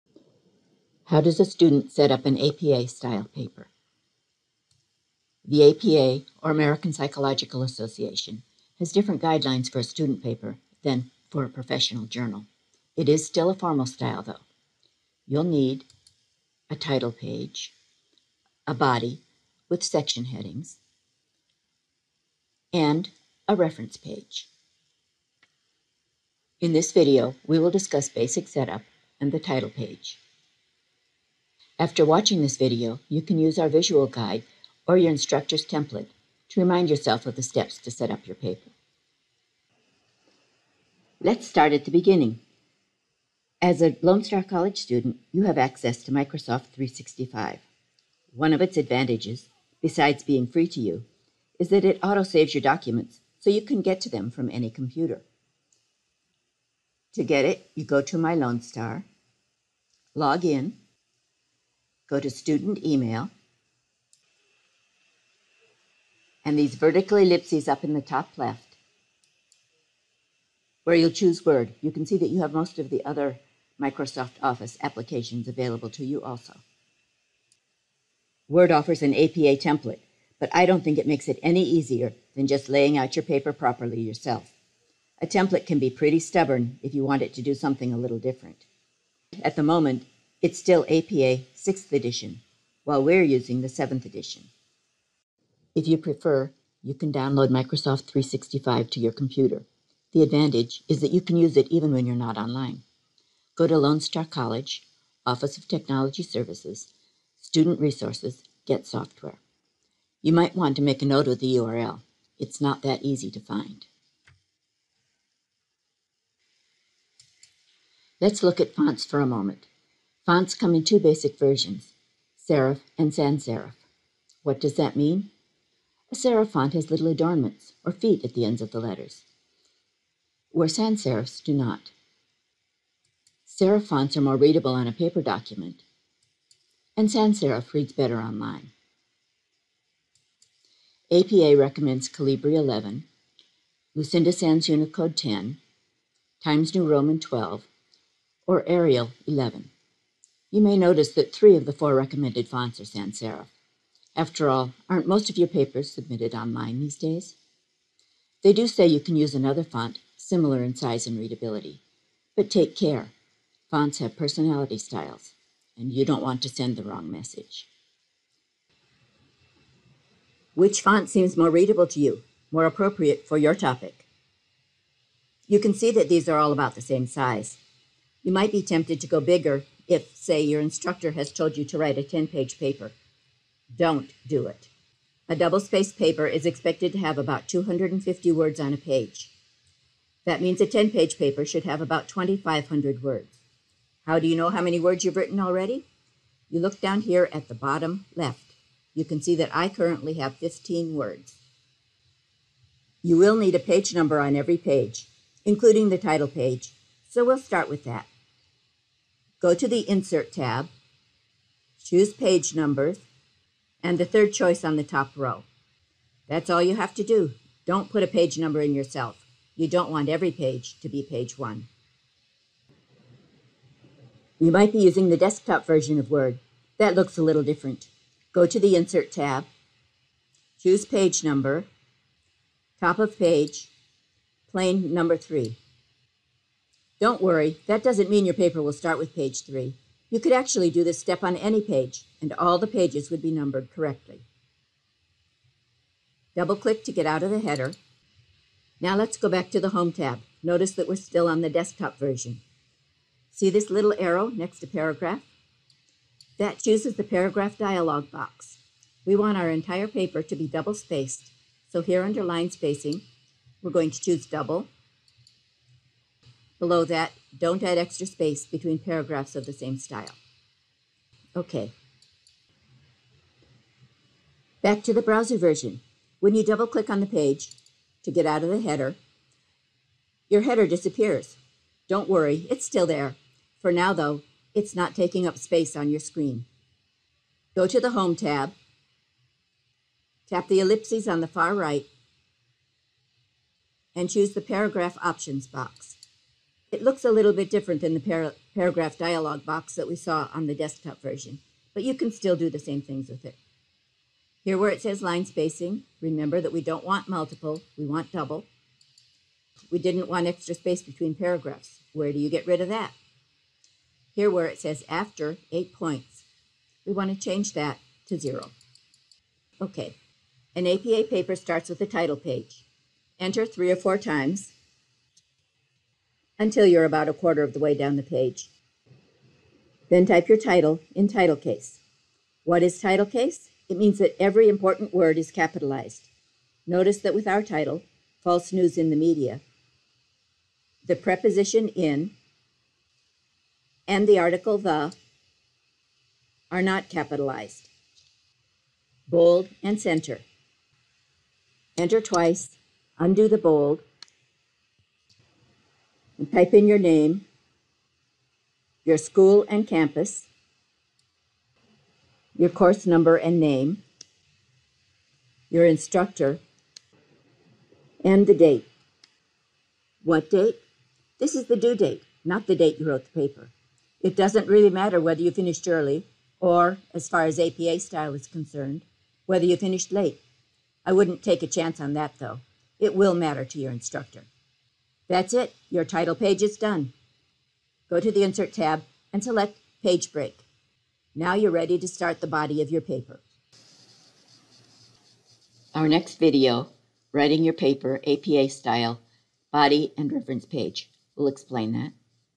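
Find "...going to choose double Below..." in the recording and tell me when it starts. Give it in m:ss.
4:23.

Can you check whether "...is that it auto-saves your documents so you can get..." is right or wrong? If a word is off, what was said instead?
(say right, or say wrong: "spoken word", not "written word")
right.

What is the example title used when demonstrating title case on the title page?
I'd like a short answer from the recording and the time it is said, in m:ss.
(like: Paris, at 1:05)
False News in the Media, at 5:38.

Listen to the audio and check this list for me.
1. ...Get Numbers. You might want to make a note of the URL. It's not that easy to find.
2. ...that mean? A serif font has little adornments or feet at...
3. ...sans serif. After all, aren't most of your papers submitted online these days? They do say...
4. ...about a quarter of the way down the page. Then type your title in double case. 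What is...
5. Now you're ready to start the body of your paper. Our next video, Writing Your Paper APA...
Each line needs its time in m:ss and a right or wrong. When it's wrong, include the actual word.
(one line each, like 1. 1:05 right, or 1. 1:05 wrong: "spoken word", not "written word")
1. 1:48 wrong: "Software", not "Numbers"
2. 2:04 right
3. 2:32 right
4. 5:26 wrong: "title", not "double"
5. 6:31 right.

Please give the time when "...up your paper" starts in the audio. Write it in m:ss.
0:38.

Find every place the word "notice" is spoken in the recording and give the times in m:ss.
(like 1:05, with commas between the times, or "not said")
2:30, 4:10, 5:36.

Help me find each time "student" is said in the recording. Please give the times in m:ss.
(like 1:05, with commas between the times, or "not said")
0:01, 0:09, 0:44, 1:02, 1:47.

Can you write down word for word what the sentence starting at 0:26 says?
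In this video, we will discuss basic setup and the title page.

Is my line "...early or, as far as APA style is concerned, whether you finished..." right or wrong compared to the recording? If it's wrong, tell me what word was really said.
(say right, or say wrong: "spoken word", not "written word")
right.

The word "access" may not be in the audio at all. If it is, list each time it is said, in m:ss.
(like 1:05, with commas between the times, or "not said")
0:45.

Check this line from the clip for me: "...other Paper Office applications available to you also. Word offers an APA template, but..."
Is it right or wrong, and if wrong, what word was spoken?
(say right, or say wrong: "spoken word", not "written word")
wrong: "Microsoft", not "Paper".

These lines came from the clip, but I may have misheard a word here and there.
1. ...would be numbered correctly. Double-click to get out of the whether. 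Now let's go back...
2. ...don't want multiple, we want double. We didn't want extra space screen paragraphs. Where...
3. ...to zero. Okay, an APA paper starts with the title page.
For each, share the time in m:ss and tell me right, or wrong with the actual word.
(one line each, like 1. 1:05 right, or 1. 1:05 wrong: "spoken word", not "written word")
1. 4:03 wrong: "header", not "whether"
2. 5:06 wrong: "between", not "screen"
3. 5:18 right.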